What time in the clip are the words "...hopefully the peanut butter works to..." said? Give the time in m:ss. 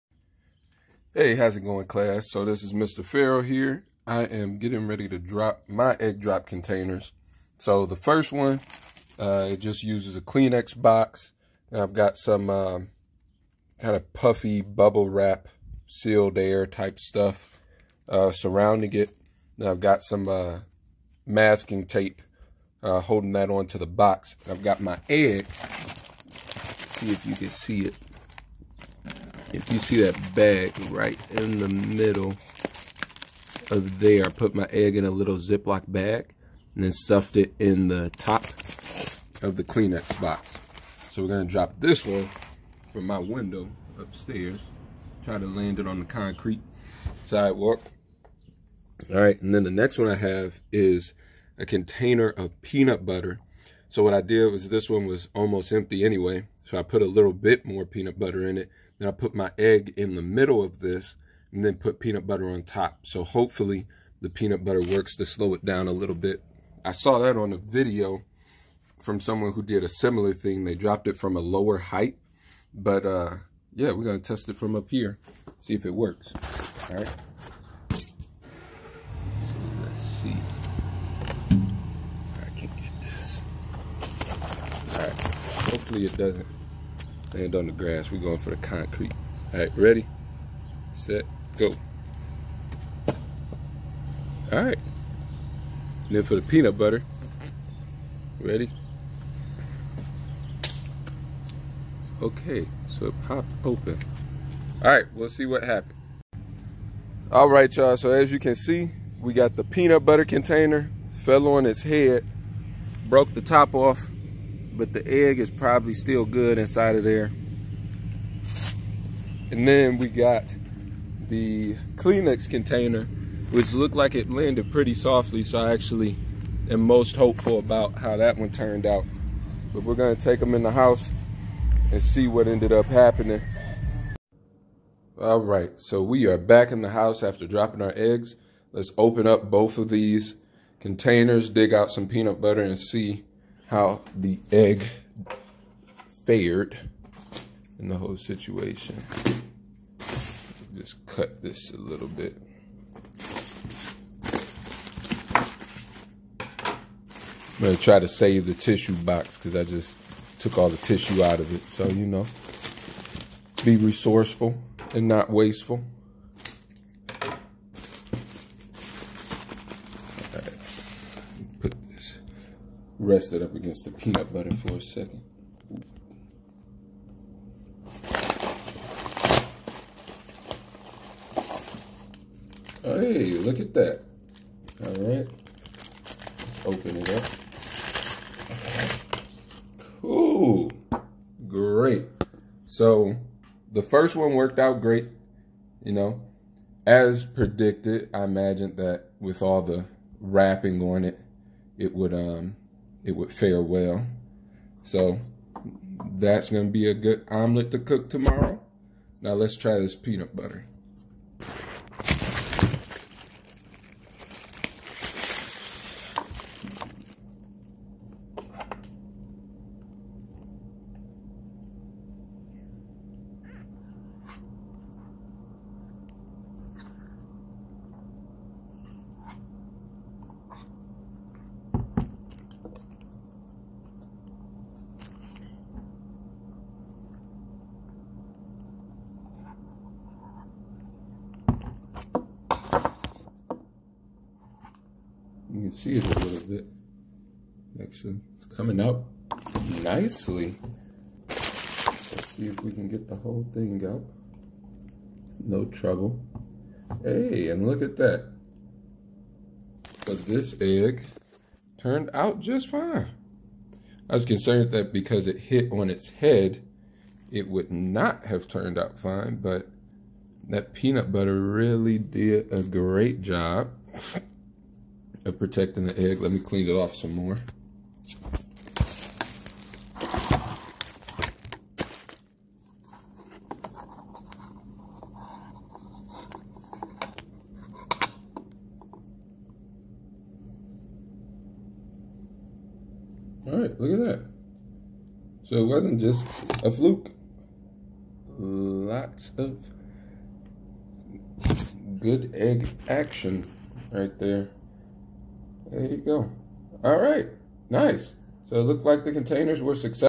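1:03.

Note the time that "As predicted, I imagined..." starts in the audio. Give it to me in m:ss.
3:16.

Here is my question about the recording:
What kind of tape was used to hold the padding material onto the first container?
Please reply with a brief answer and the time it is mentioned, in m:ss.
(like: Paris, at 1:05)
masking tape, at 0:21.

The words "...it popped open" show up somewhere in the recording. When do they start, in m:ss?
1:43.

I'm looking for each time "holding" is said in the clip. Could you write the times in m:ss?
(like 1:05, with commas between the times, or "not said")
0:23.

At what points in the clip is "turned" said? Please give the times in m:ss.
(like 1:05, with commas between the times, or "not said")
2:08, 4:21, 4:28.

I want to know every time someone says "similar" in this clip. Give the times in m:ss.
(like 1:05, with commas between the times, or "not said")
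1:09.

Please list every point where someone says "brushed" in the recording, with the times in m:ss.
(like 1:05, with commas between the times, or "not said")
not said.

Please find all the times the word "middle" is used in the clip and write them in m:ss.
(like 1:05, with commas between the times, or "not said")
0:31, 1:00.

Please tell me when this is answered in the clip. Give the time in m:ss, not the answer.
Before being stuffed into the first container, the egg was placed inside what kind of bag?
0:35.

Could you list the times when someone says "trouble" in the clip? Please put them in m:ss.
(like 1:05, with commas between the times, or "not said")
4:15.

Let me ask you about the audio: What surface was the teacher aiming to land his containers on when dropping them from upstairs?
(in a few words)
concrete sidewalk.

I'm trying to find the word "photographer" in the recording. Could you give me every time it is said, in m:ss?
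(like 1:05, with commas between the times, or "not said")
not said.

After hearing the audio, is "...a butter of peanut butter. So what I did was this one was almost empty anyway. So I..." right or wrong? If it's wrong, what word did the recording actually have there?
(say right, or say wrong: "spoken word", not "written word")
wrong: "container", not "butter".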